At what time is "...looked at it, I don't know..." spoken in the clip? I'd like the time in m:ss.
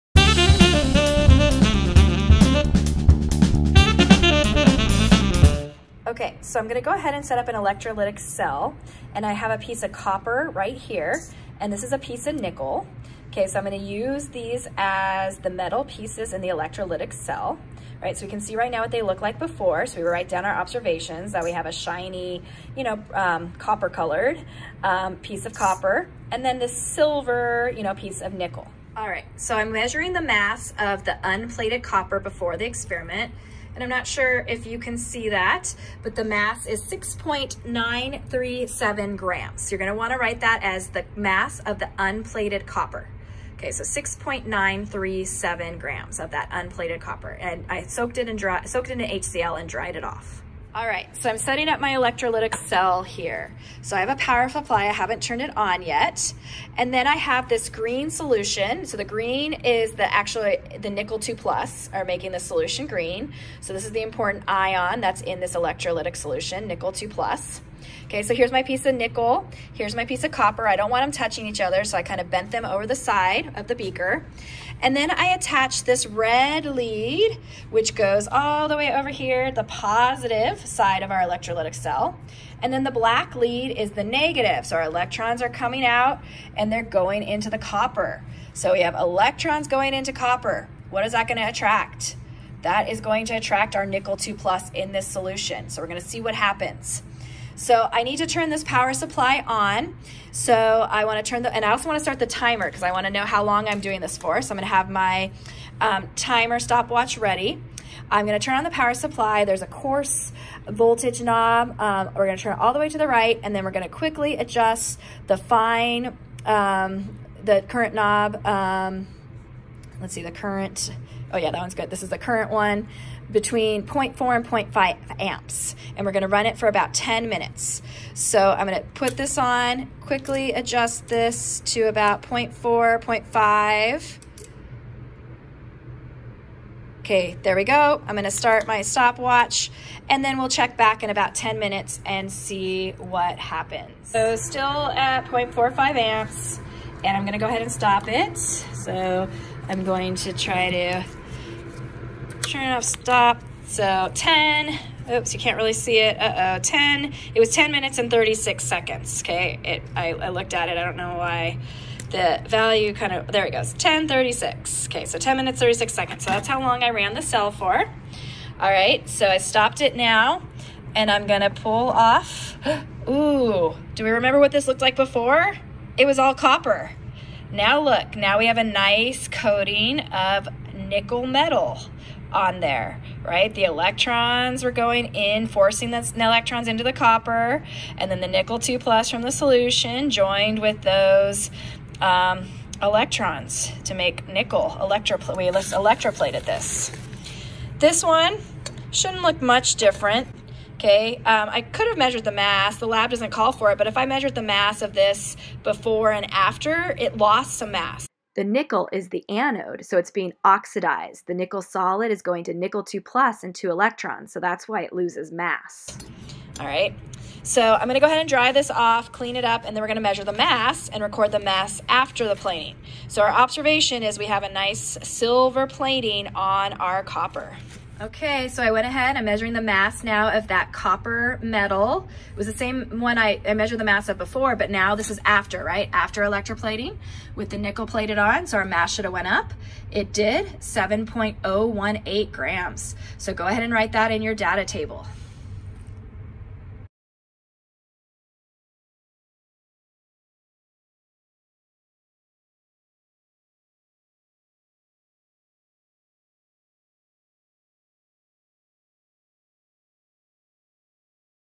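2:40.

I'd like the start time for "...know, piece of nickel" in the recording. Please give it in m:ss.
0:27.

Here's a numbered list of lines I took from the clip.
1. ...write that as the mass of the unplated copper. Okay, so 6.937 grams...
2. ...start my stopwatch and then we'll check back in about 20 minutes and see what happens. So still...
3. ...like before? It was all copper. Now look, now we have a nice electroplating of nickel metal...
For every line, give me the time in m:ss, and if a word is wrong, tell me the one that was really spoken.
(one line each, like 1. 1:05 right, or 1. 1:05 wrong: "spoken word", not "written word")
1. 0:40 right
2. 2:18 wrong: "10", not "20"
3. 2:54 wrong: "coating", not "electroplating".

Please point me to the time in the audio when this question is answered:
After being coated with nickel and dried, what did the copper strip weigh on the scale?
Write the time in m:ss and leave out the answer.
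4:00.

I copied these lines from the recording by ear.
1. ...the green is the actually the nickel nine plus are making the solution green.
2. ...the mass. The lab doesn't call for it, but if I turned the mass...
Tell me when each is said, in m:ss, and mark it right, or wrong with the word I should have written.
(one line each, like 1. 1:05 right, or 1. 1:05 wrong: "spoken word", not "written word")
1. 0:58 wrong: "two", not "nine"
2. 3:22 wrong: "measured", not "turned".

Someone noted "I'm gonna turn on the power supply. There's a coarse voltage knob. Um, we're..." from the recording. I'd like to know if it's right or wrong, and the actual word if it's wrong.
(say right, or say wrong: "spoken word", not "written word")
right.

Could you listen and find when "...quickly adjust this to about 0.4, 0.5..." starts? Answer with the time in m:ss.
2:10.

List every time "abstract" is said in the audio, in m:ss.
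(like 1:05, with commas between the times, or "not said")
not said.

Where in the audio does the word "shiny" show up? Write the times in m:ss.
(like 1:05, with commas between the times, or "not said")
0:21.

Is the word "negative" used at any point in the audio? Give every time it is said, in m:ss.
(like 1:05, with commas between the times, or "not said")
1:24.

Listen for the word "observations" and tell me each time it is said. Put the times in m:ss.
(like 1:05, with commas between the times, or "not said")
0:20, 3:43.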